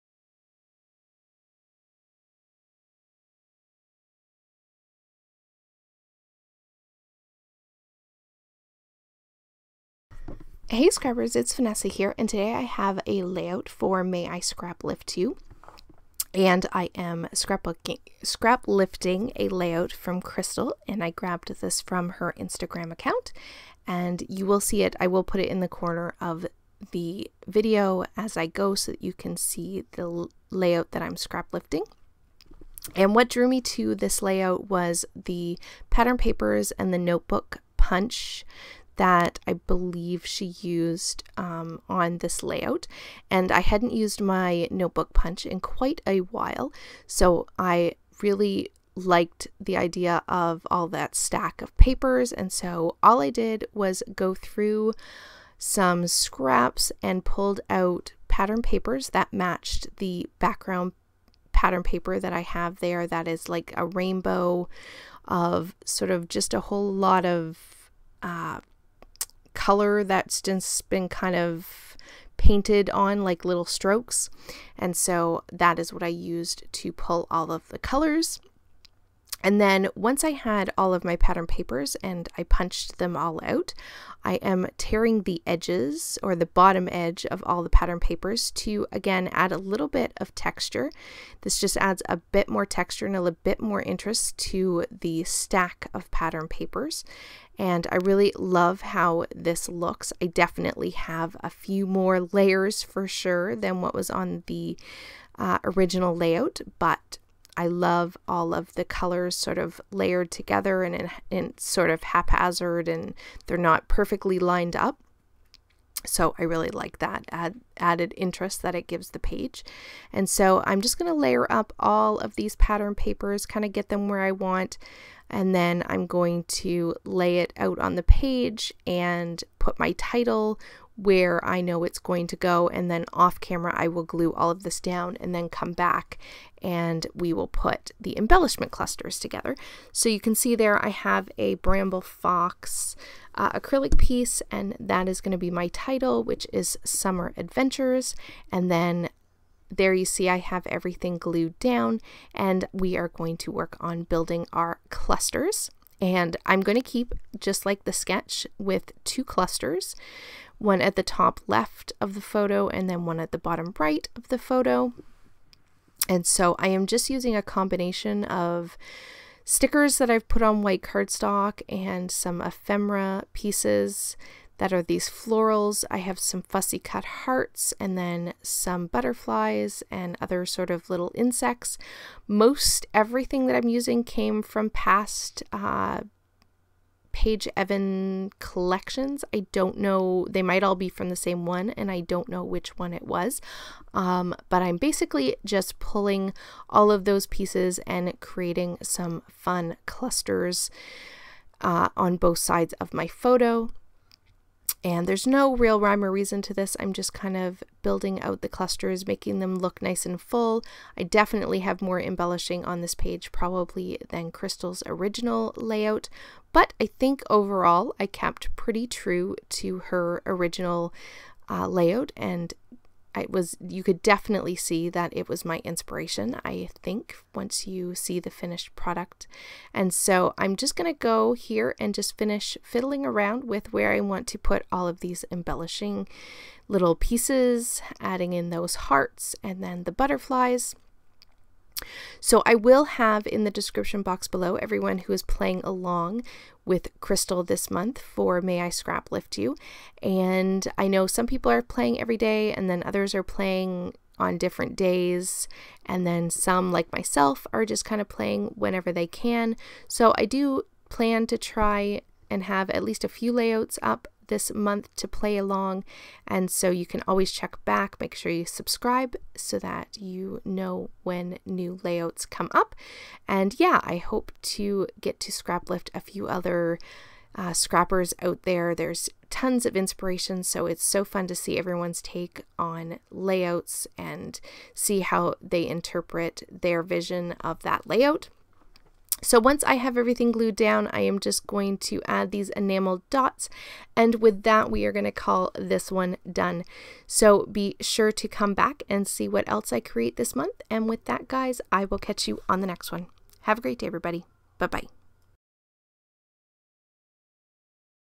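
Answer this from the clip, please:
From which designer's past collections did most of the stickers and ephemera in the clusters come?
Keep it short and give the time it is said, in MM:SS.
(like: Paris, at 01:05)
Paige Evans, at 03:07.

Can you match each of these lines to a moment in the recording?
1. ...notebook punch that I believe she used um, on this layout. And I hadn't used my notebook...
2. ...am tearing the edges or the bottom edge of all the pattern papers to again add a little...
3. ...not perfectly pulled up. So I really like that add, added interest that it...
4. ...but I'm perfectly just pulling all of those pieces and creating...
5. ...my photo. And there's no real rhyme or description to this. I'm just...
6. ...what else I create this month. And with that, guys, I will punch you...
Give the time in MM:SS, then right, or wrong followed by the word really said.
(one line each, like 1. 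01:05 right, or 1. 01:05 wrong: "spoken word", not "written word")
1. 00:36 right
2. 01:24 right
3. 01:53 wrong: "lined", not "pulled"
4. 03:14 wrong: "basically", not "perfectly"
5. 03:22 wrong: "reason", not "description"
6. 04:59 wrong: "catch", not "punch".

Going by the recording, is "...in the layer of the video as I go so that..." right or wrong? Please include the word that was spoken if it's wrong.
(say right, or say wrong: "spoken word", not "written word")
wrong: "corner", not "layer".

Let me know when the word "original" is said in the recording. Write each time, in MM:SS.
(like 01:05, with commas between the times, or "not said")
01:45, 03:34, 03:40.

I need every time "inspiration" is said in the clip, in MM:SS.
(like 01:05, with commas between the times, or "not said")
03:45, 04:39.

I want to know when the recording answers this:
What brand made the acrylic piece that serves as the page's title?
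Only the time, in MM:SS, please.
02:21.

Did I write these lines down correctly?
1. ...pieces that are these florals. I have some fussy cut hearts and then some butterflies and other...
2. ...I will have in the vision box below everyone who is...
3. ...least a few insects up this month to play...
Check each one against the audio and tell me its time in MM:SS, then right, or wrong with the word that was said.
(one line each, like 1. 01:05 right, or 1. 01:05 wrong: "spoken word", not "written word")
1. 02:53 right
2. 04:02 wrong: "description", not "vision"
3. 04:22 wrong: "layouts", not "insects".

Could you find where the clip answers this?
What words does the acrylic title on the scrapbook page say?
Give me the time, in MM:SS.
02:26.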